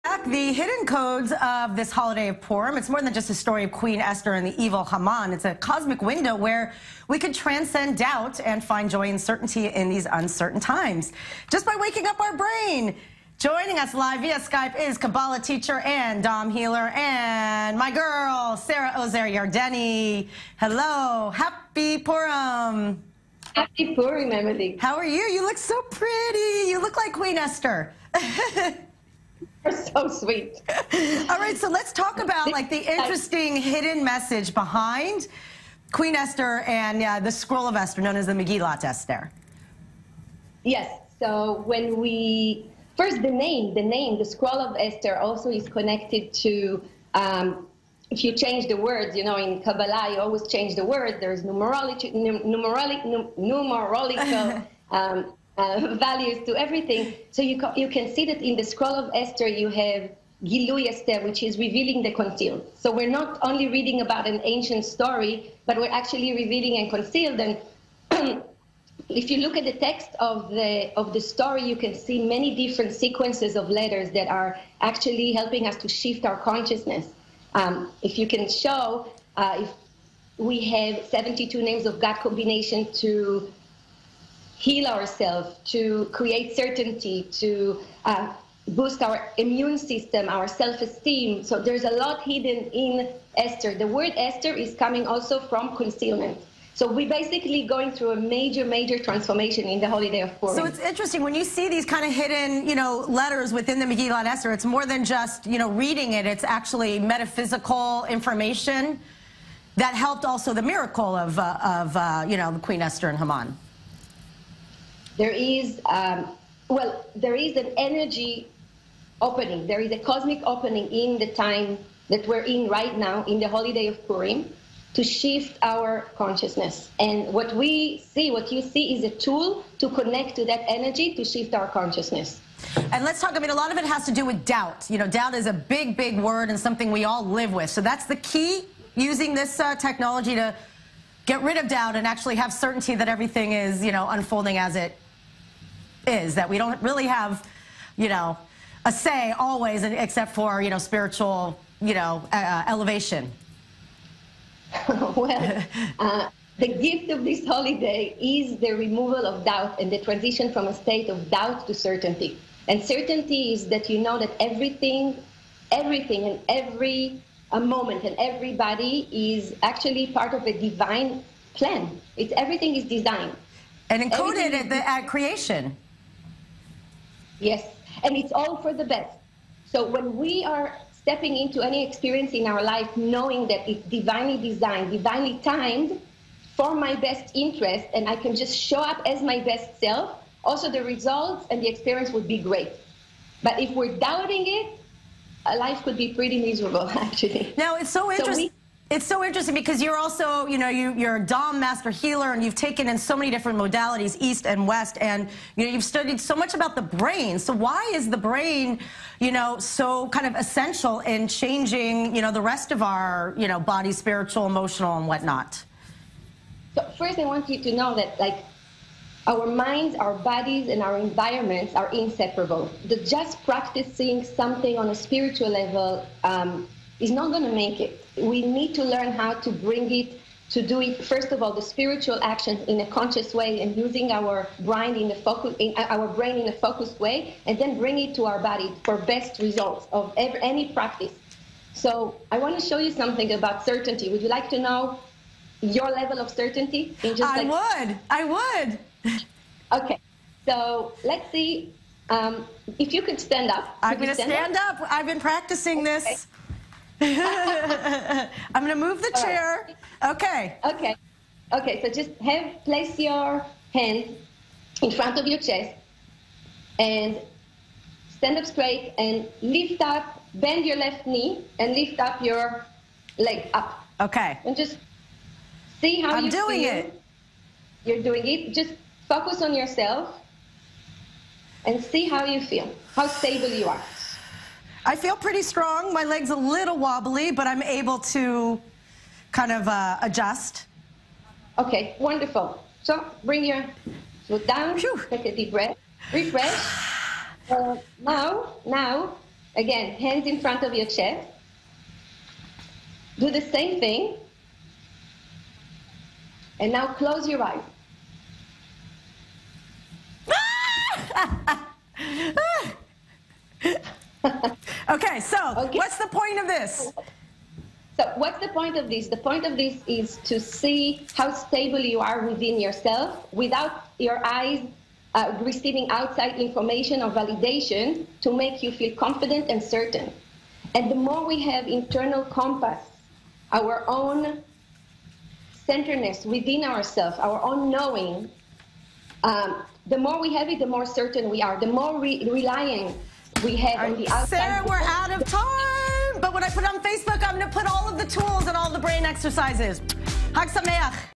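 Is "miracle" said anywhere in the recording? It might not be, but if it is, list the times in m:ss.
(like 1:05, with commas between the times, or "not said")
1:50.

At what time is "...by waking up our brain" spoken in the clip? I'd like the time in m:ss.
0:11.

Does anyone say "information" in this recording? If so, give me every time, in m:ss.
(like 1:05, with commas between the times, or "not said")
1:48, 5:26.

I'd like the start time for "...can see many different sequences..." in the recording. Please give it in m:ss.
1:11.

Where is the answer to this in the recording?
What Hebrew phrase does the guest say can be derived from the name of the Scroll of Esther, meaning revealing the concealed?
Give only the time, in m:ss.
1:00.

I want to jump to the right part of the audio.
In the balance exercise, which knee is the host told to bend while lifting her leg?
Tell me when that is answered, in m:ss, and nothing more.
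4:30.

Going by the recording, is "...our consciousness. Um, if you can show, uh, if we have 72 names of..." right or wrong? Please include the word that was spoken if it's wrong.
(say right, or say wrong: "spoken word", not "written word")
right.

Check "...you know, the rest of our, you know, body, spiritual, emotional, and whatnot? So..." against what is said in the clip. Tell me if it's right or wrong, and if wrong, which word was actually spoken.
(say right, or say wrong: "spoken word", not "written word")
right.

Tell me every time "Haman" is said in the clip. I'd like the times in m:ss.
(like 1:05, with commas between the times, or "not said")
0:04, 1:53.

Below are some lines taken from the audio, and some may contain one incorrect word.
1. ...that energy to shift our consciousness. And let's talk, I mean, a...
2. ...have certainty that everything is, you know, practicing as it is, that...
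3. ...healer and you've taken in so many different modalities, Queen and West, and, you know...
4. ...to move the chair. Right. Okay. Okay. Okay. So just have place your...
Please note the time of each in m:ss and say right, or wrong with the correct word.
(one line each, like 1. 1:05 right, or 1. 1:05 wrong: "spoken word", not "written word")
1. 2:10 right
2. 2:22 wrong: "unfolding", not "practicing"
3. 3:21 wrong: "East", not "Queen"
4. 4:18 right.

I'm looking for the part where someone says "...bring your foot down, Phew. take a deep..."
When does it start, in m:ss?
4:53.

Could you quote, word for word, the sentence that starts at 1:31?
So there's a lot hidden in Esther.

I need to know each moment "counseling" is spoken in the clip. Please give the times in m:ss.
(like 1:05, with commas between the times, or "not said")
not said.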